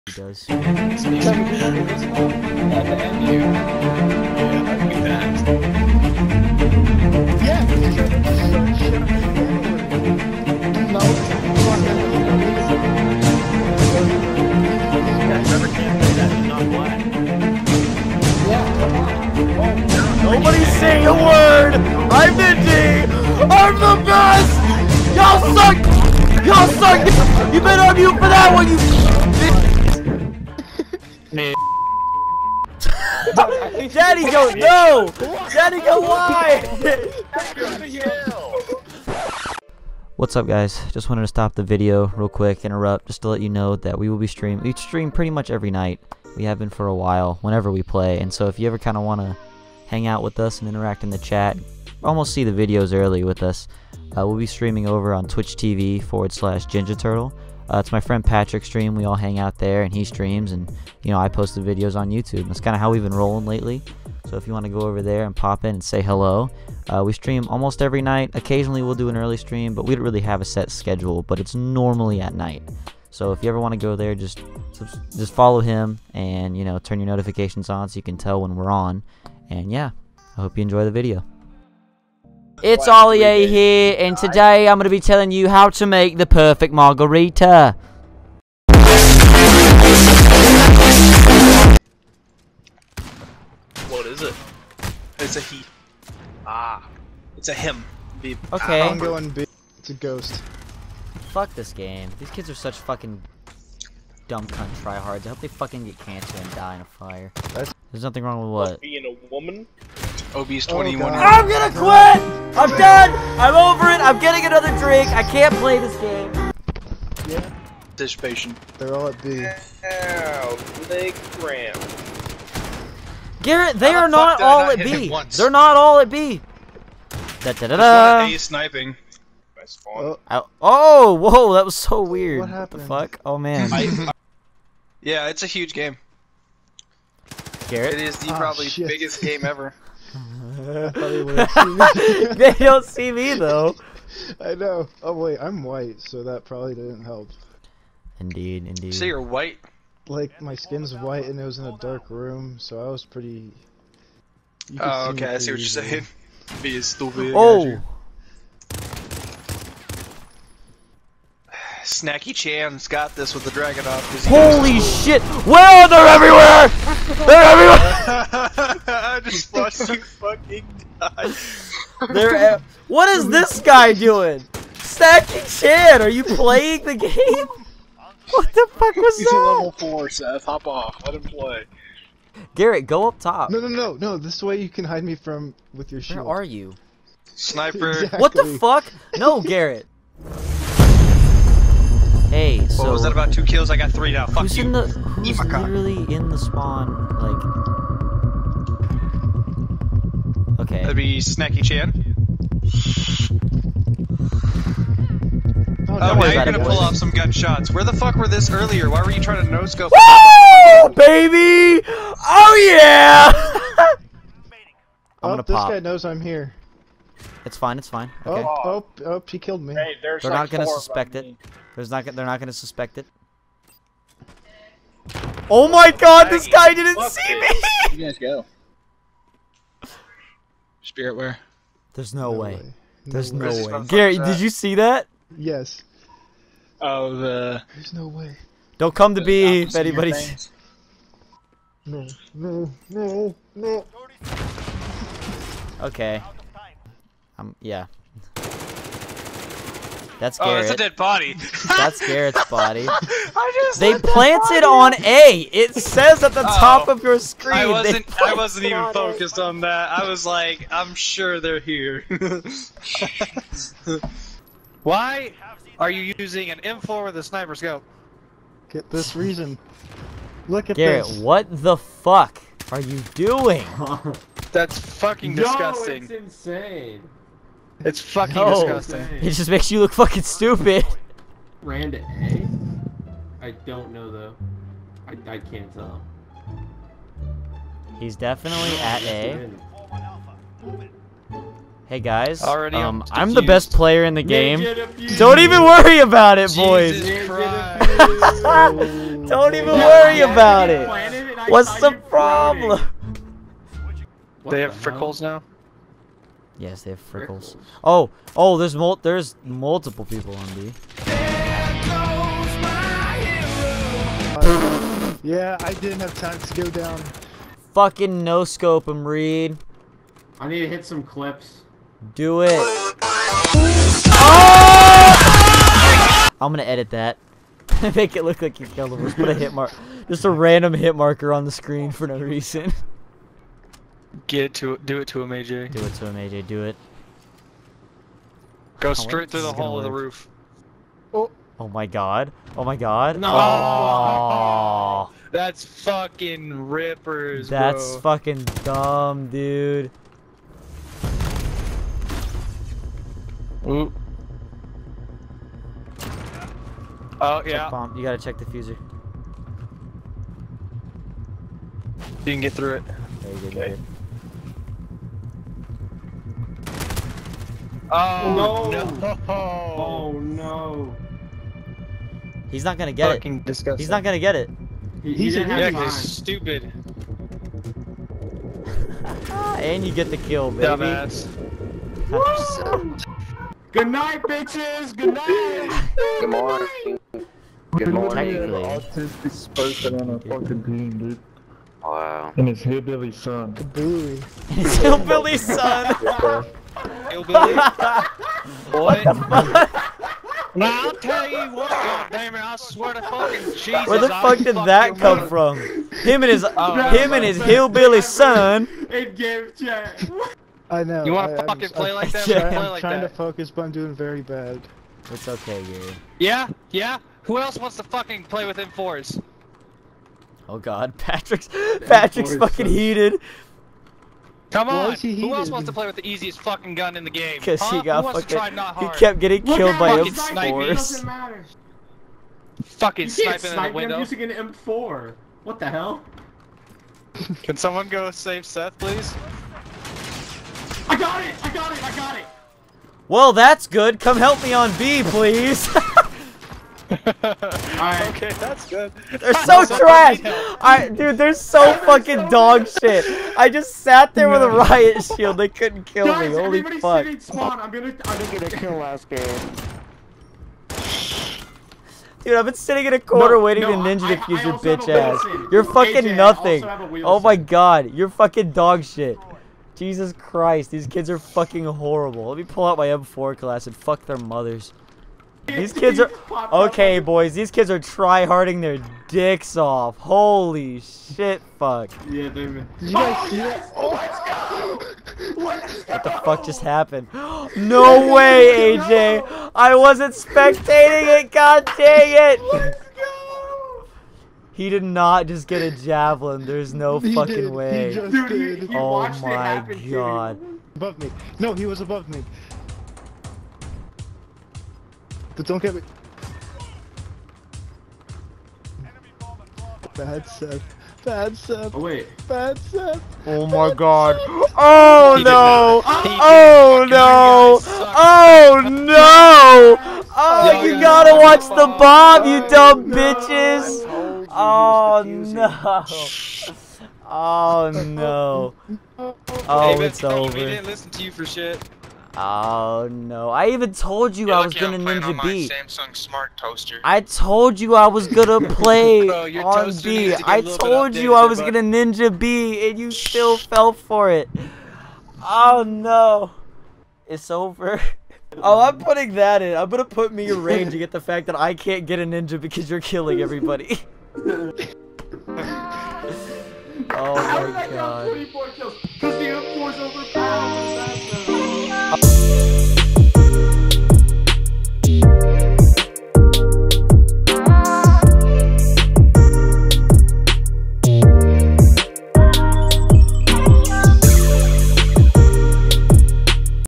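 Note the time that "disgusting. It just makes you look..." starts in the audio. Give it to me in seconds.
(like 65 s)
278 s.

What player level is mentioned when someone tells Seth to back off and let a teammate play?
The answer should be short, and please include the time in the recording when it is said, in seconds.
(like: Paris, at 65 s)
4, at 179 s.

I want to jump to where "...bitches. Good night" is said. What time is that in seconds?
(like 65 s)
384 s.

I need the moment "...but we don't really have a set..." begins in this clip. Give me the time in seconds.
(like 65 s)
69 s.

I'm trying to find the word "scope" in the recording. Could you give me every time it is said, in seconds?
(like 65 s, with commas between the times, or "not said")
267 s, 318 s.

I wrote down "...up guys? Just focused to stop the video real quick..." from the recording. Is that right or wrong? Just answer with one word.
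wrong.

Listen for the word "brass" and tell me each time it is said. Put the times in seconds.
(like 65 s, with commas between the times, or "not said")
not said.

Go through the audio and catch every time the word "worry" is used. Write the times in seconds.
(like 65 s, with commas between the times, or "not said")
295 s, 299 s.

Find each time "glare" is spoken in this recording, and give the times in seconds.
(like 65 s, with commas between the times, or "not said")
not said.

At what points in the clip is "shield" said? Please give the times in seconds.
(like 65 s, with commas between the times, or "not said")
186 s, 455 s.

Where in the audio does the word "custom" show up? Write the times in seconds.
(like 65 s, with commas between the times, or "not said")
not said.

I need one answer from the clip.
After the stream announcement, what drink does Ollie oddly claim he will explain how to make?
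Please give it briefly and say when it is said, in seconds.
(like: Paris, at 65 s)
margarita, at 86 s.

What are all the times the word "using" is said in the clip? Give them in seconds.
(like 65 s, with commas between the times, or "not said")
266 s, 434 s.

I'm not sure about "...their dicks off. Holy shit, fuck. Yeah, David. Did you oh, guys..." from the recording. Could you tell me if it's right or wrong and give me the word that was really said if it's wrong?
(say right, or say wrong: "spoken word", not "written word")
right.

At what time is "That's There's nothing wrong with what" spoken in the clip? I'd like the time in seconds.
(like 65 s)
107 s.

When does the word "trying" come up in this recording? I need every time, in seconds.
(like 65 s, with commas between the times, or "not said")
209 s, 412 s.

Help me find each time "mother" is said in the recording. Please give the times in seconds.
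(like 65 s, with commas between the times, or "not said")
405 s, 474 s.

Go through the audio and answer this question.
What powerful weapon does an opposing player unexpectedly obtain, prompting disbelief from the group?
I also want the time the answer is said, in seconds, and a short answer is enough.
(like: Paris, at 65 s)
javelin, at 495 s.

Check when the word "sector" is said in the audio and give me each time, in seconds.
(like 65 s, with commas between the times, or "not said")
not said.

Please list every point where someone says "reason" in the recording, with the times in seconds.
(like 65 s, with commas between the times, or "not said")
269 s, 332 s.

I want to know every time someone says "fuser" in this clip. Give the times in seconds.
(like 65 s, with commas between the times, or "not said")
358 s.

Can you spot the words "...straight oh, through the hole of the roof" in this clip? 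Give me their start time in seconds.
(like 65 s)
338 s.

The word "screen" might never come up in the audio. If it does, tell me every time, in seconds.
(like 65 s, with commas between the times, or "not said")
257 s, 331 s.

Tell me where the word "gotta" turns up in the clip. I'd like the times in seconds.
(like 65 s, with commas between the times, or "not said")
358 s, 520 s.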